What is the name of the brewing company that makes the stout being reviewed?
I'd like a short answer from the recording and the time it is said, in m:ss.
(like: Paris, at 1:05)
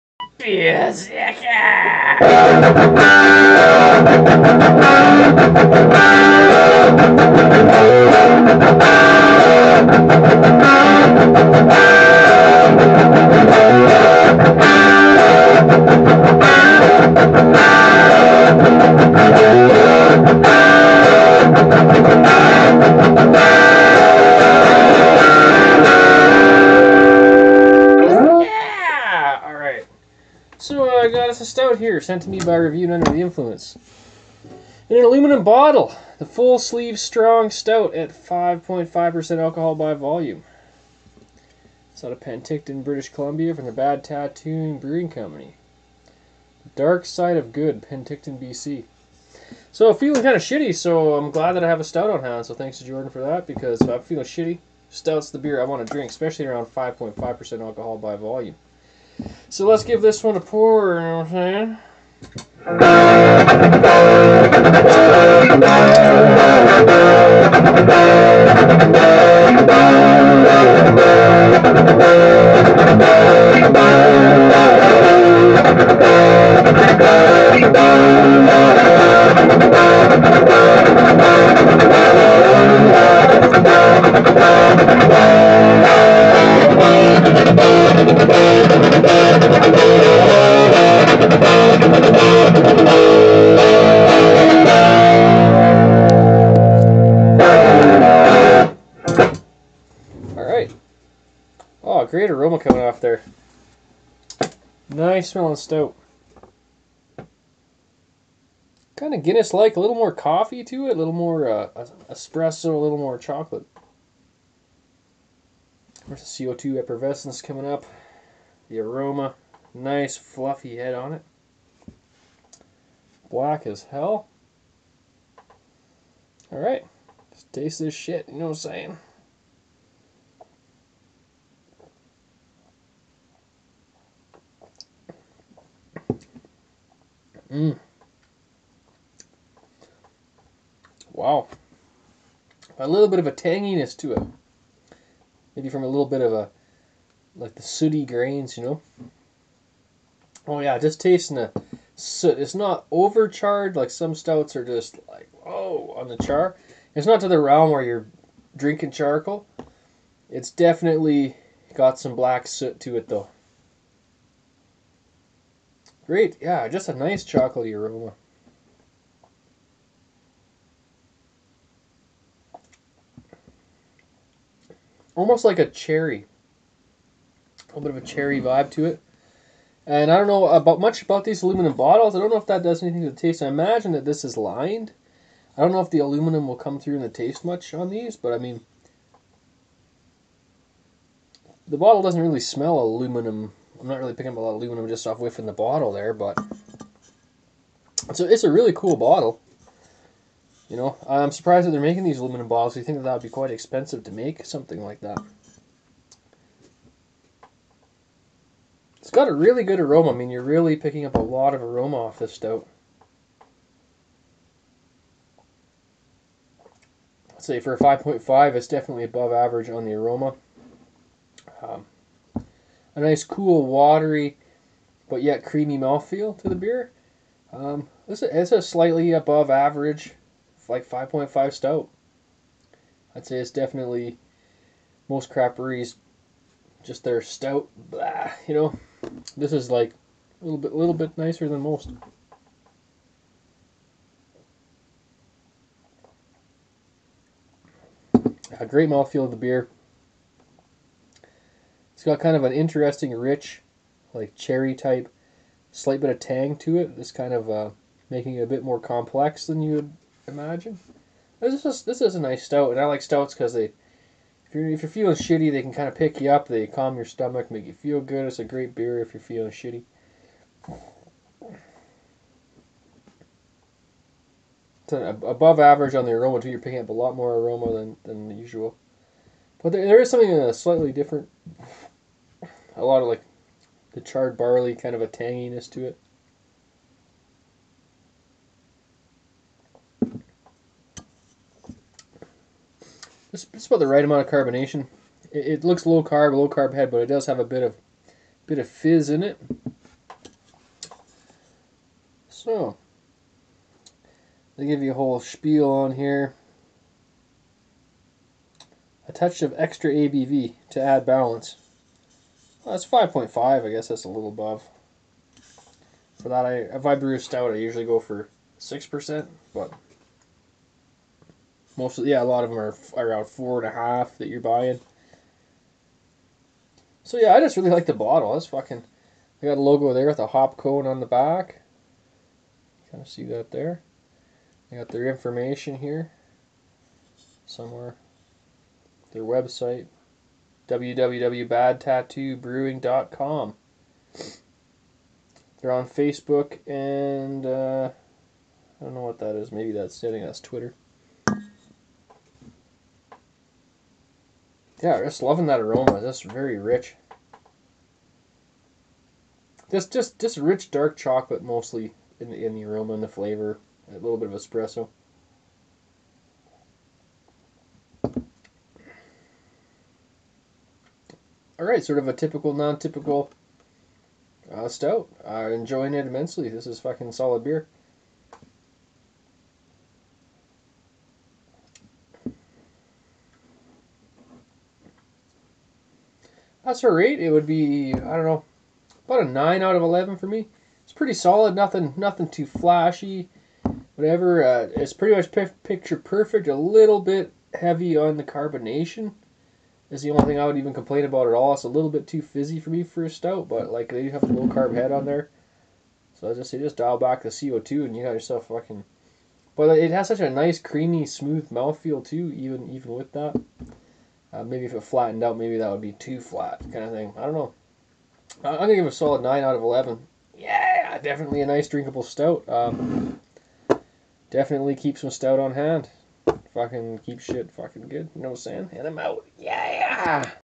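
Bad Tattoo Brewing Company, at 0:43.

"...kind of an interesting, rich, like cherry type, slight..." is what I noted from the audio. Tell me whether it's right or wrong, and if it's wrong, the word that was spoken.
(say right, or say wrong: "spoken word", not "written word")
right.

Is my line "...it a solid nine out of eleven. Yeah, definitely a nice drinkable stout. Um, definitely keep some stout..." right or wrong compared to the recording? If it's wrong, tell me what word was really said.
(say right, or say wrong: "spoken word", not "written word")
right.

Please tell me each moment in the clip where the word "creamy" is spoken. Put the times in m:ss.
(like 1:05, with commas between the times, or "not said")
3:45, 6:50.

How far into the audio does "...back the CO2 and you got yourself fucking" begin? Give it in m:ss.
6:46.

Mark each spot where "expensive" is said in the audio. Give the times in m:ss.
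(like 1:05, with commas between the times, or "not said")
3:23.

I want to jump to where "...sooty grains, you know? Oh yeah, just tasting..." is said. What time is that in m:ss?
2:27.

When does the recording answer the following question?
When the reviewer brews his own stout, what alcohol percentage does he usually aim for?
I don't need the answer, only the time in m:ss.
5:17.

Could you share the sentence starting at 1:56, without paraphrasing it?
There's the CO2 effervescence coming up.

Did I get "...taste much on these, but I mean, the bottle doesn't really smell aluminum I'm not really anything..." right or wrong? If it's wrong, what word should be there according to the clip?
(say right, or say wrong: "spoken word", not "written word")
wrong: "picking", not "anything".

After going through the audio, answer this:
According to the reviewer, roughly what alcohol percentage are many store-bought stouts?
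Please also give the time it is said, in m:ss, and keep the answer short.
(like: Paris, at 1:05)
4.5%, at 5:23.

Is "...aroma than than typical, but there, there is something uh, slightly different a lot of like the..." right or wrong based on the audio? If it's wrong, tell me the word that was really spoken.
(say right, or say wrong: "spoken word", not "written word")
wrong: "usual", not "typical".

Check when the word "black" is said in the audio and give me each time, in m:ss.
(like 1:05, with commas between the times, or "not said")
2:03, 2:42.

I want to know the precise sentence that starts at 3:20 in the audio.
You know, I'm surprised that they're making these aluminum bottles.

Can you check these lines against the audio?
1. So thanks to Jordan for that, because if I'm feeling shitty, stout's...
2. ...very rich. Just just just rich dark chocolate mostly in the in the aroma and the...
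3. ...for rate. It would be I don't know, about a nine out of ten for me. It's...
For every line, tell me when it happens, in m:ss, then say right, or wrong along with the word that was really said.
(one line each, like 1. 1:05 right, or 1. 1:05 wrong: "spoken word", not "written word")
1. 0:52 right
2. 5:56 right
3. 6:26 wrong: "eleven", not "ten".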